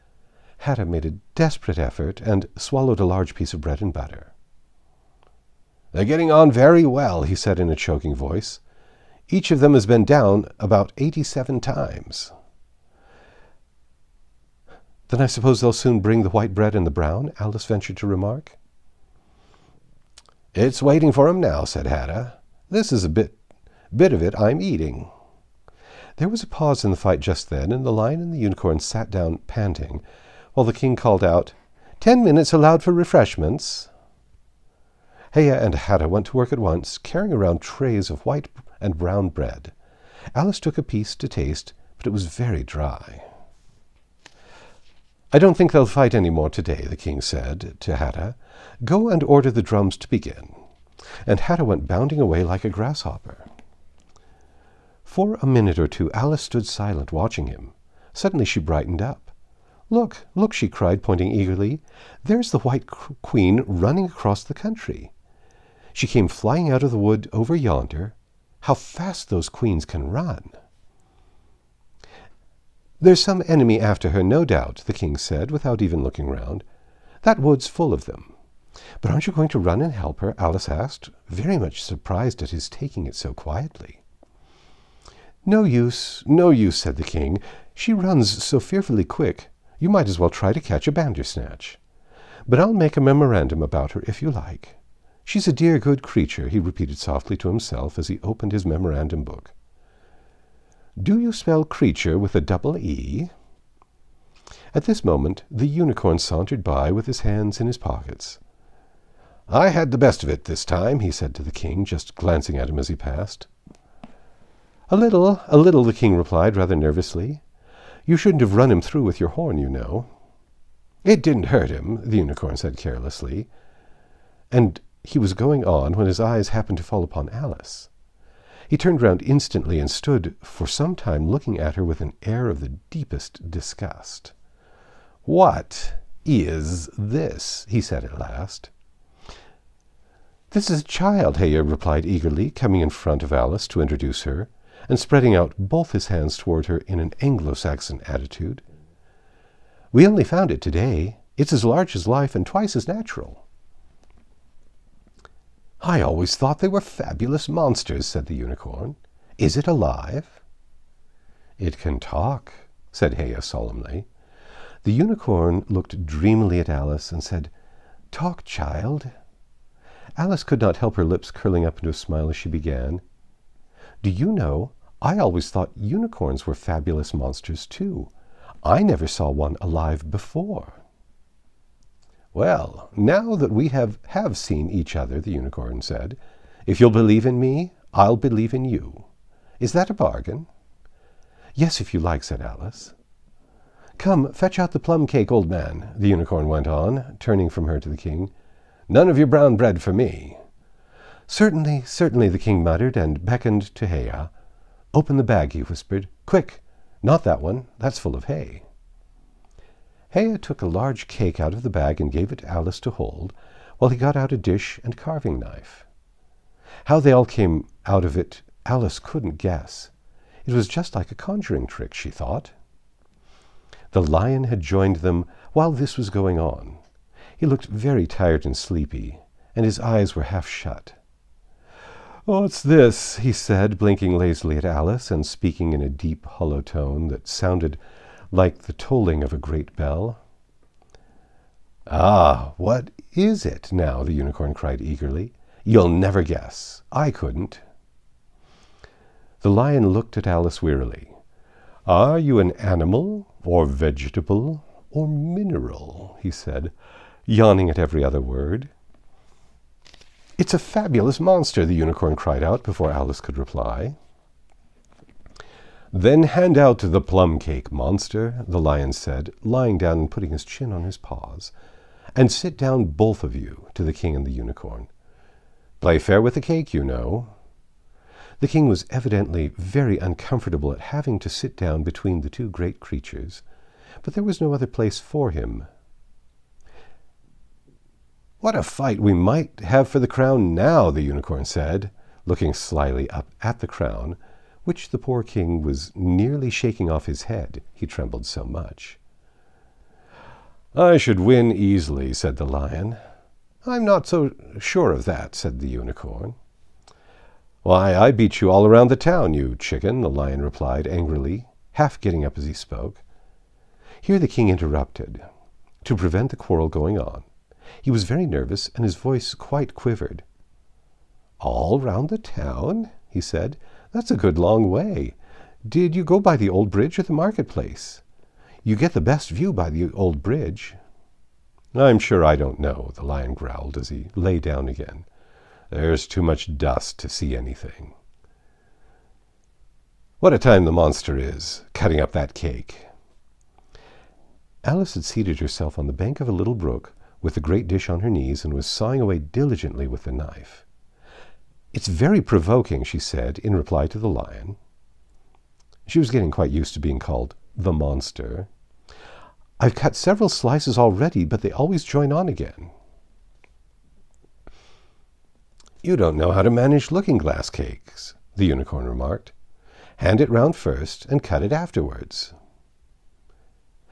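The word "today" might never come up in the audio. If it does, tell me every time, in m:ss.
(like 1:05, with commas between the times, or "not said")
0:46, 2:30.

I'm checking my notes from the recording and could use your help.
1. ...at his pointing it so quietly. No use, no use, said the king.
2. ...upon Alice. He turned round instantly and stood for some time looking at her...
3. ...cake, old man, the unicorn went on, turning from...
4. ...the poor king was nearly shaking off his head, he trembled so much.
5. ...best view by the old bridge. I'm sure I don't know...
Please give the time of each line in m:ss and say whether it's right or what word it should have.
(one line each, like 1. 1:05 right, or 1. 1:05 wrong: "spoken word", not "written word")
1. 1:22 wrong: "taking", not "pointing"
2. 2:07 right
3. 3:15 right
4. 4:54 right
5. 5:29 right.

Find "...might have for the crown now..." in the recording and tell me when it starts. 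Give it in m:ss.
4:49.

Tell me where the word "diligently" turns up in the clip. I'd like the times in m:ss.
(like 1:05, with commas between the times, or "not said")
5:49.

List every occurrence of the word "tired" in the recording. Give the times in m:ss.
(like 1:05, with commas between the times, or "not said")
3:48.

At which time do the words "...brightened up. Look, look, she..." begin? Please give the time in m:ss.
0:58.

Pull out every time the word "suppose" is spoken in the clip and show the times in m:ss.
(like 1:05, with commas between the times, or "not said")
0:15.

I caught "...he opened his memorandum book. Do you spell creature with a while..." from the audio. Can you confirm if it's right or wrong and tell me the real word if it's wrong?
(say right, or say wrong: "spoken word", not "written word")
wrong: "double", not "while".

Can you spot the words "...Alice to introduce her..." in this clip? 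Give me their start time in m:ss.
2:23.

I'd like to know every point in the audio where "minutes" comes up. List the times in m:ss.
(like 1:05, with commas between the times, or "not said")
0:32, 0:55.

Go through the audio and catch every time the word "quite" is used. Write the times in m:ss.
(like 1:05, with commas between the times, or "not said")
5:19, 5:56.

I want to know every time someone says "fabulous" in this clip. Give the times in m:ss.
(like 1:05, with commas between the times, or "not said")
2:36, 2:56, 4:20.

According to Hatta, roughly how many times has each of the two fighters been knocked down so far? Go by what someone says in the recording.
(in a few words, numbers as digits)
87.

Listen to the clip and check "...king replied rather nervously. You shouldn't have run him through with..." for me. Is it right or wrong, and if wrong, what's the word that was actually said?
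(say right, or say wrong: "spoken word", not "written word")
right.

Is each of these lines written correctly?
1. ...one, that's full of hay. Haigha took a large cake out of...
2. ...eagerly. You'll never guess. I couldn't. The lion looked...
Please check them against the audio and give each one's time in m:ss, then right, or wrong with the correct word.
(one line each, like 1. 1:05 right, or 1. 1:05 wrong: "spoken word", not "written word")
1. 3:27 right
2. 4:04 right.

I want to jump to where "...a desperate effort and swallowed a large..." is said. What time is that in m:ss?
0:01.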